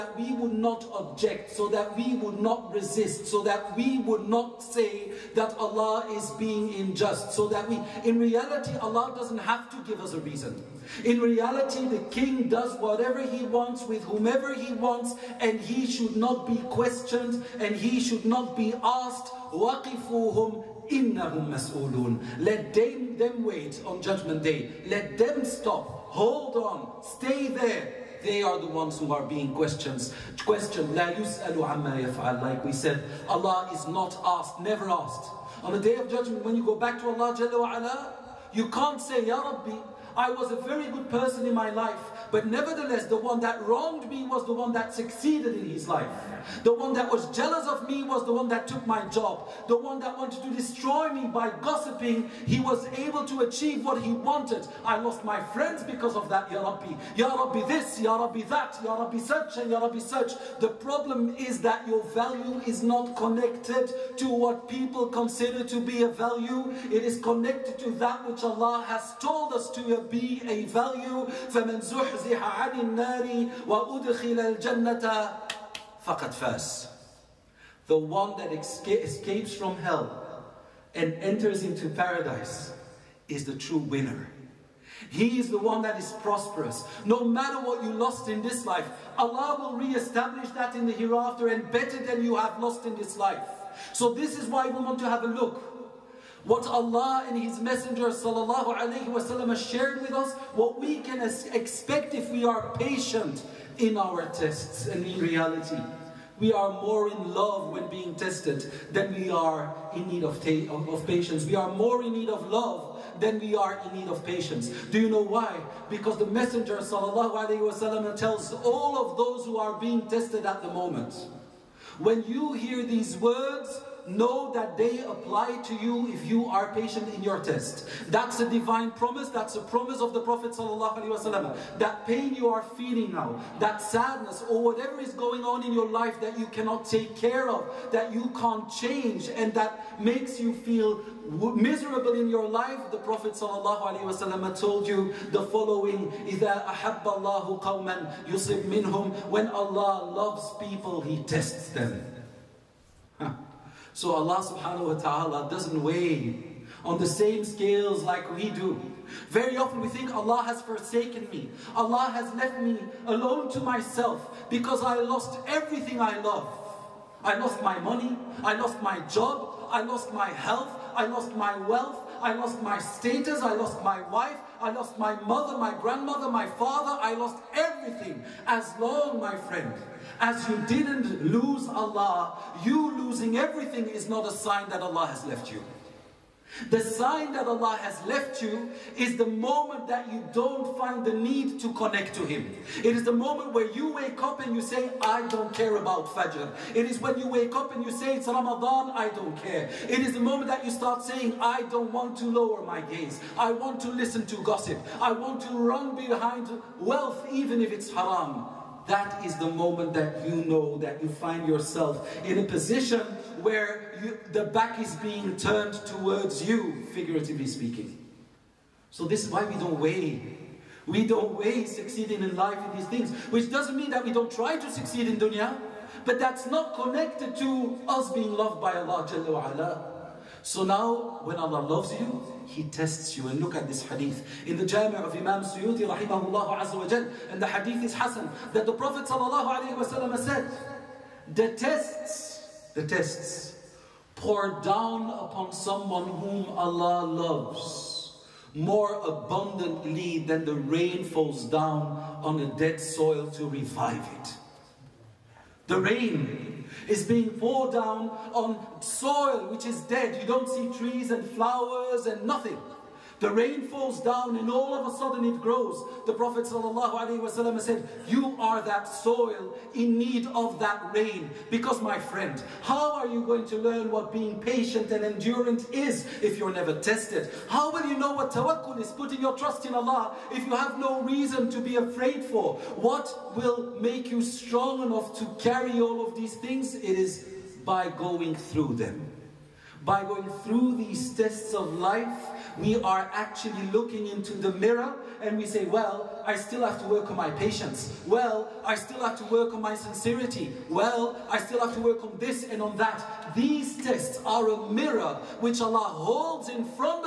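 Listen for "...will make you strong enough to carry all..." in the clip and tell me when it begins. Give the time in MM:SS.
04:43.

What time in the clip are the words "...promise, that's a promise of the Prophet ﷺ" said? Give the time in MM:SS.
02:08.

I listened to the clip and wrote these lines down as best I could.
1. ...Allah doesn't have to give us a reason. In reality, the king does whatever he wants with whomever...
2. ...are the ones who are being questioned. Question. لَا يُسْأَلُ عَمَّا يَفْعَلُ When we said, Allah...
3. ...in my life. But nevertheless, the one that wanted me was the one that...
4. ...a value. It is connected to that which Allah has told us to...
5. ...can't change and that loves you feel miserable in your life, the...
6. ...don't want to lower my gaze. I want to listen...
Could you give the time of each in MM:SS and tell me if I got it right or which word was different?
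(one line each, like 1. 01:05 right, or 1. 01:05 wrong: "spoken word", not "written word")
1. 00:08 right
2. 00:28 wrong: "Like", not "When"
3. 00:41 wrong: "wronged", not "wanted"
4. 01:06 right
5. 02:18 wrong: "makes", not "loves"
6. 03:21 right.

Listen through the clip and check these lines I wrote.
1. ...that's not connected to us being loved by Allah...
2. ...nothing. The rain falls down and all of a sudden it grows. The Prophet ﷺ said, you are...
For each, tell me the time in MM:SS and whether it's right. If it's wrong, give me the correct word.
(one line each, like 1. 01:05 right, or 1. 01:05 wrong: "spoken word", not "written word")
1. 03:46 right
2. 04:22 right.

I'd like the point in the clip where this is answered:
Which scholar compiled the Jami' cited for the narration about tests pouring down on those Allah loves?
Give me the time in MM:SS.
03:55.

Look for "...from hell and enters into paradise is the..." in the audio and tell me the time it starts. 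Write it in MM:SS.
01:19.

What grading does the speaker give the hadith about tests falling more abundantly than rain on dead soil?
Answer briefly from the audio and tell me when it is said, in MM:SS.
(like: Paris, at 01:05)
Hassan, at 03:57.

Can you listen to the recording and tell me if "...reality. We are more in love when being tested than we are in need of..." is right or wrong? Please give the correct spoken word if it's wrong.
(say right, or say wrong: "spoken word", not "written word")
right.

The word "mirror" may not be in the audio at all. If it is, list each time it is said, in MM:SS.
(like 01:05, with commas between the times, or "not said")
04:54, 05:04.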